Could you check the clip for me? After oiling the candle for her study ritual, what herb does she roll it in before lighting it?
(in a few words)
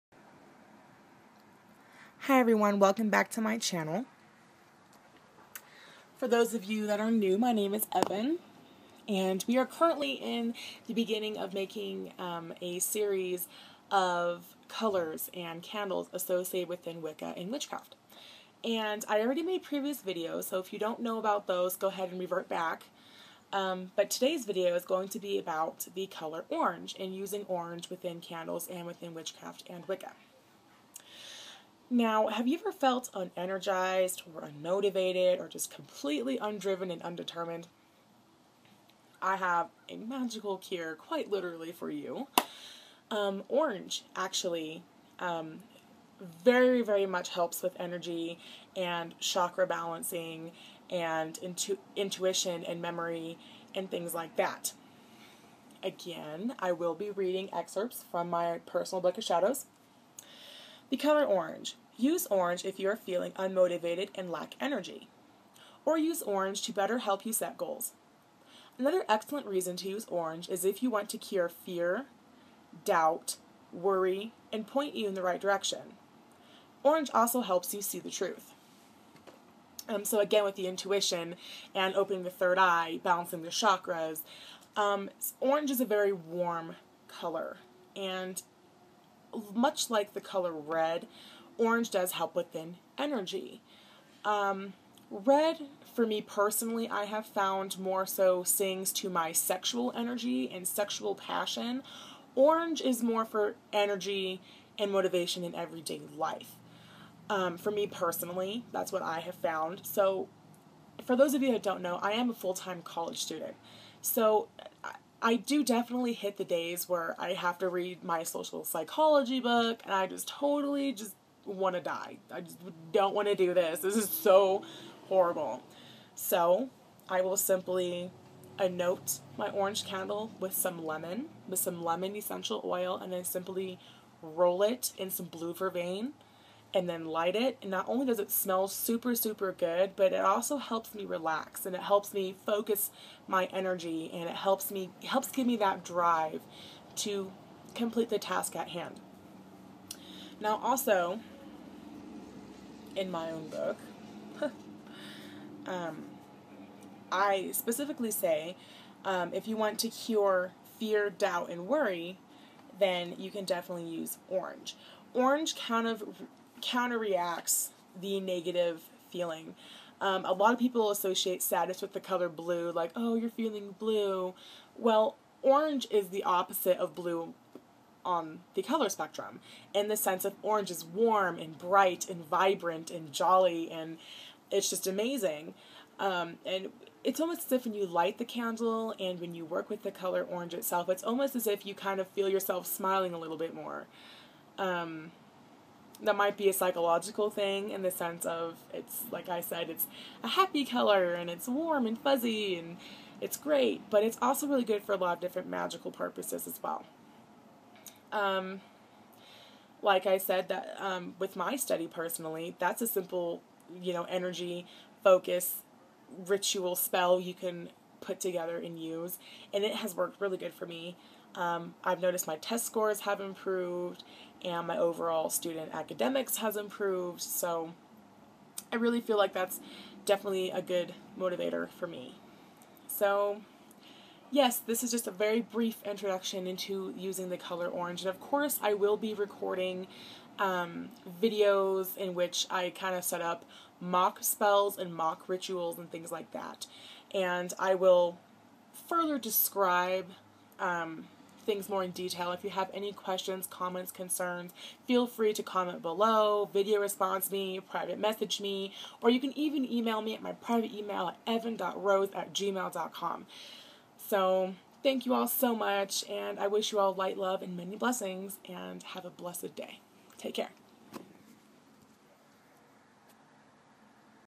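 Blue vervain.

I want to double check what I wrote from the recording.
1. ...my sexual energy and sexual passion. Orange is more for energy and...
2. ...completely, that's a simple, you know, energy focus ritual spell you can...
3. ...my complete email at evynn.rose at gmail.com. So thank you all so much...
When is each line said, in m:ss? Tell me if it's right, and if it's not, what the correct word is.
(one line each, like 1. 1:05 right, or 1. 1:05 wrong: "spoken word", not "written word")
1. 1:39 right
2. 3:31 wrong: "personally", not "completely"
3. 4:20 wrong: "private", not "complete".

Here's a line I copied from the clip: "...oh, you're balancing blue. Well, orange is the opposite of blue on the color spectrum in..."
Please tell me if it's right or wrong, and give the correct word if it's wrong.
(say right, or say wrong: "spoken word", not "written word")
wrong: "feeling", not "balancing".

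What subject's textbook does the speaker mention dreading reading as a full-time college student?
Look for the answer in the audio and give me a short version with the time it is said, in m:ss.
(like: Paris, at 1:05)
Social psychology, at 1:58.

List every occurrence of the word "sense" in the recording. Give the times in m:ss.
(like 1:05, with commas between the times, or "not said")
2:59, 3:17.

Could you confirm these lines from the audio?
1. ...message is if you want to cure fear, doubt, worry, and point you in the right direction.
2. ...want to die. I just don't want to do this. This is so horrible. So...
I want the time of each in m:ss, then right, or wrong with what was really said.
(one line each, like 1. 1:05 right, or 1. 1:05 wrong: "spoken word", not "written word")
1. 1:10 wrong: "orange", not "message"
2. 2:01 right.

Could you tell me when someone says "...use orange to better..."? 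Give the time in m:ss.
1:05.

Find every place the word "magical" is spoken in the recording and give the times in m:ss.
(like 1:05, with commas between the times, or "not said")
0:39, 3:25.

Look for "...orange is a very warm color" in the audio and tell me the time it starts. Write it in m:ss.
1:25.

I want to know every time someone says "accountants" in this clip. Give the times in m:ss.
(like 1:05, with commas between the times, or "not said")
not said.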